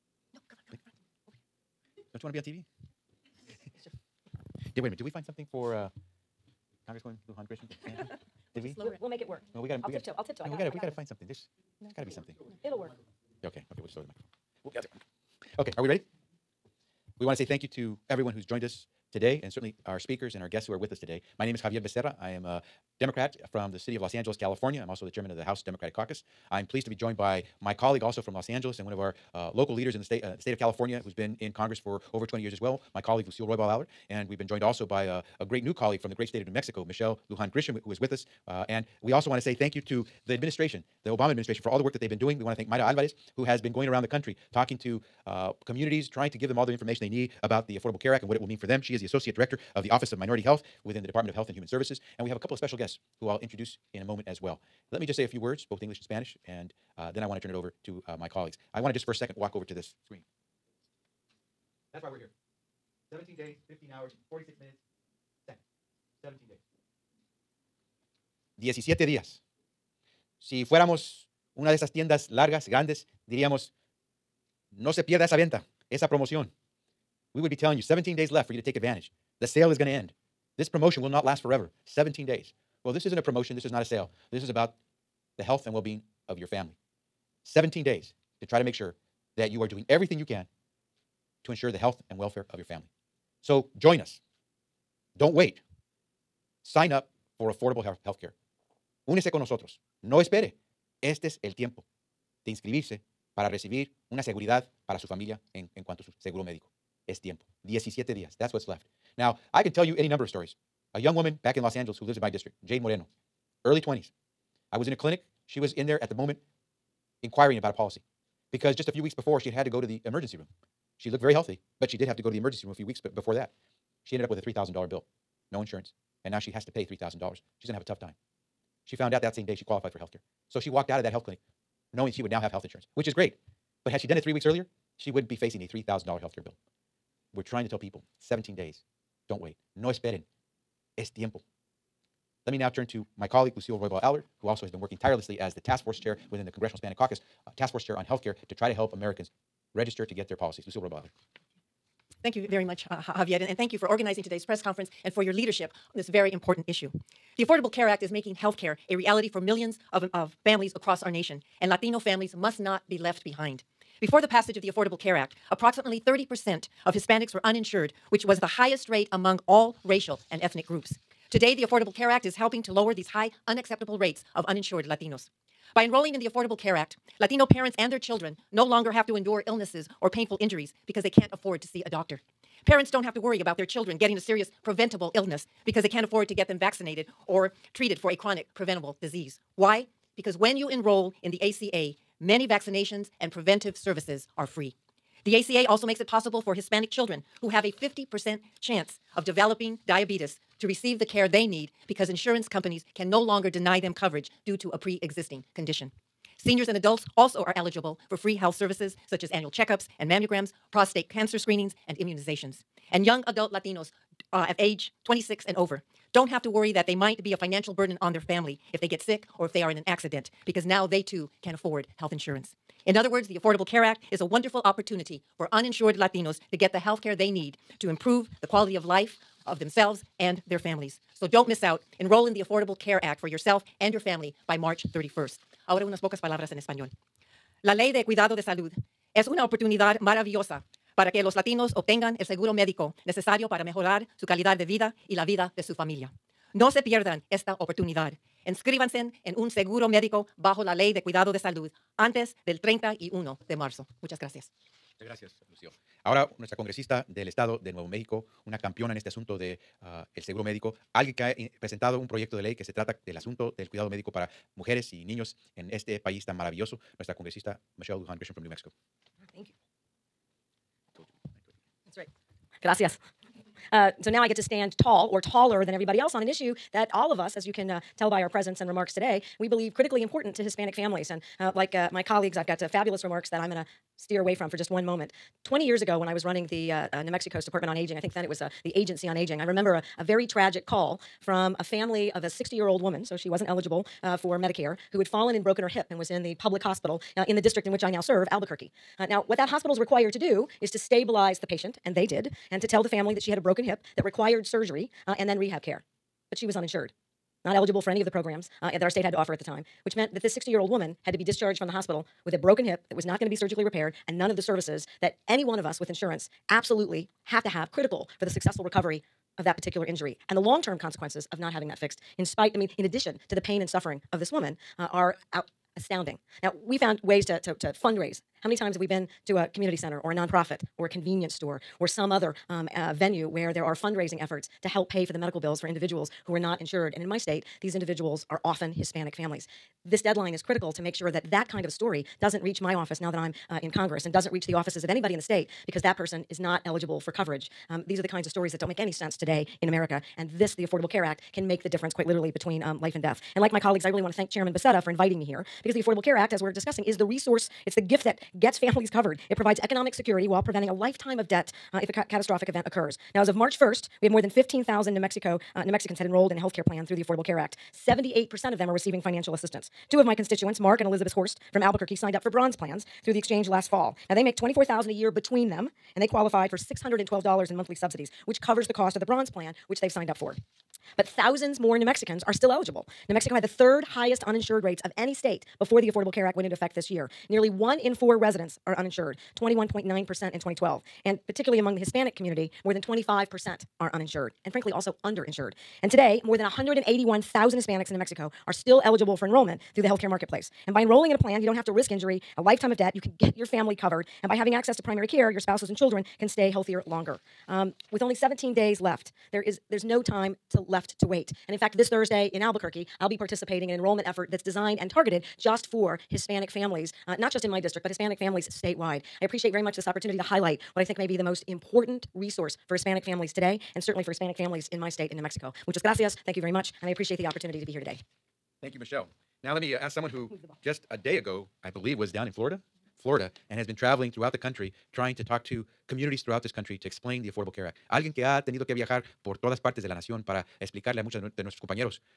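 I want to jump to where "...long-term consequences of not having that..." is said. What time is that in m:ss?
5:20.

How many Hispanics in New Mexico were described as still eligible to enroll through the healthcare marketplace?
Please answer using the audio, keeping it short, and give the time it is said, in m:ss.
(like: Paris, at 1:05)
181,000, at 6:36.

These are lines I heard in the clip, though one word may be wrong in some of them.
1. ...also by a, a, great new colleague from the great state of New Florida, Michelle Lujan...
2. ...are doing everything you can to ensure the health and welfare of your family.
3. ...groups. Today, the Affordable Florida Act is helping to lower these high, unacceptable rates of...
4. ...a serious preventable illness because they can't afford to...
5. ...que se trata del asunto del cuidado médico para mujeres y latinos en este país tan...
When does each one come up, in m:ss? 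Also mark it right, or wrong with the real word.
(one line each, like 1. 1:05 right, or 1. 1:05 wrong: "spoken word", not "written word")
1. 0:34 wrong: "Mexico", not "Florida"
2. 1:29 right
3. 2:50 wrong: "Care", not "Florida"
4. 3:04 right
5. 4:22 wrong: "niños", not "latinos".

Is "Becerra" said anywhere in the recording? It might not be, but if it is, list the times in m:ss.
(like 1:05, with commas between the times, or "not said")
0:21, 5:54.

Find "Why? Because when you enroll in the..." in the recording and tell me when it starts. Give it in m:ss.
3:09.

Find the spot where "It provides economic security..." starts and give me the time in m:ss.
5:59.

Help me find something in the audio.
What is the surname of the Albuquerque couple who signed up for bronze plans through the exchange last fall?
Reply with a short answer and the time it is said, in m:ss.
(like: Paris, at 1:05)
Horst, at 6:11.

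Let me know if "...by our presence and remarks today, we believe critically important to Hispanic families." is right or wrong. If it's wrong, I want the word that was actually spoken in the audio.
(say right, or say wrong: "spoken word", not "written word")
right.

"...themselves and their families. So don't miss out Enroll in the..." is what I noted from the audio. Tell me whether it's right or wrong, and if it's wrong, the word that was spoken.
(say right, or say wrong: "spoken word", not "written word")
right.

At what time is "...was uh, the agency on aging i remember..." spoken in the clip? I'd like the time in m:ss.
4:48.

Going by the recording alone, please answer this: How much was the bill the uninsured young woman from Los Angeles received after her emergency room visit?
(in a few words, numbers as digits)
$3,000.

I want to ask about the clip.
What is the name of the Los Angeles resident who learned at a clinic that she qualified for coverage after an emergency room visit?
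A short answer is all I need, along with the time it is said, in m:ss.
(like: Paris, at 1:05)
Jade Moreno, at 1:52.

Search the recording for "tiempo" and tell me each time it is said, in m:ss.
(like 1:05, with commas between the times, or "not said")
1:41, 1:47, 2:21.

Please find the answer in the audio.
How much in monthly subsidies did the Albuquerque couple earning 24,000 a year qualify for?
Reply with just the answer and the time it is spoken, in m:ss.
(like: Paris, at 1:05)
$612, at 6:16.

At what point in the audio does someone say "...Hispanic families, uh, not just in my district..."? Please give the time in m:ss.
6:56.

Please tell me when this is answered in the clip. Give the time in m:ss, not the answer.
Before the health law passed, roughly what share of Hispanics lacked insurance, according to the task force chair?
2:46.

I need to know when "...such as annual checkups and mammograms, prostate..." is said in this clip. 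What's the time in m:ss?
3:29.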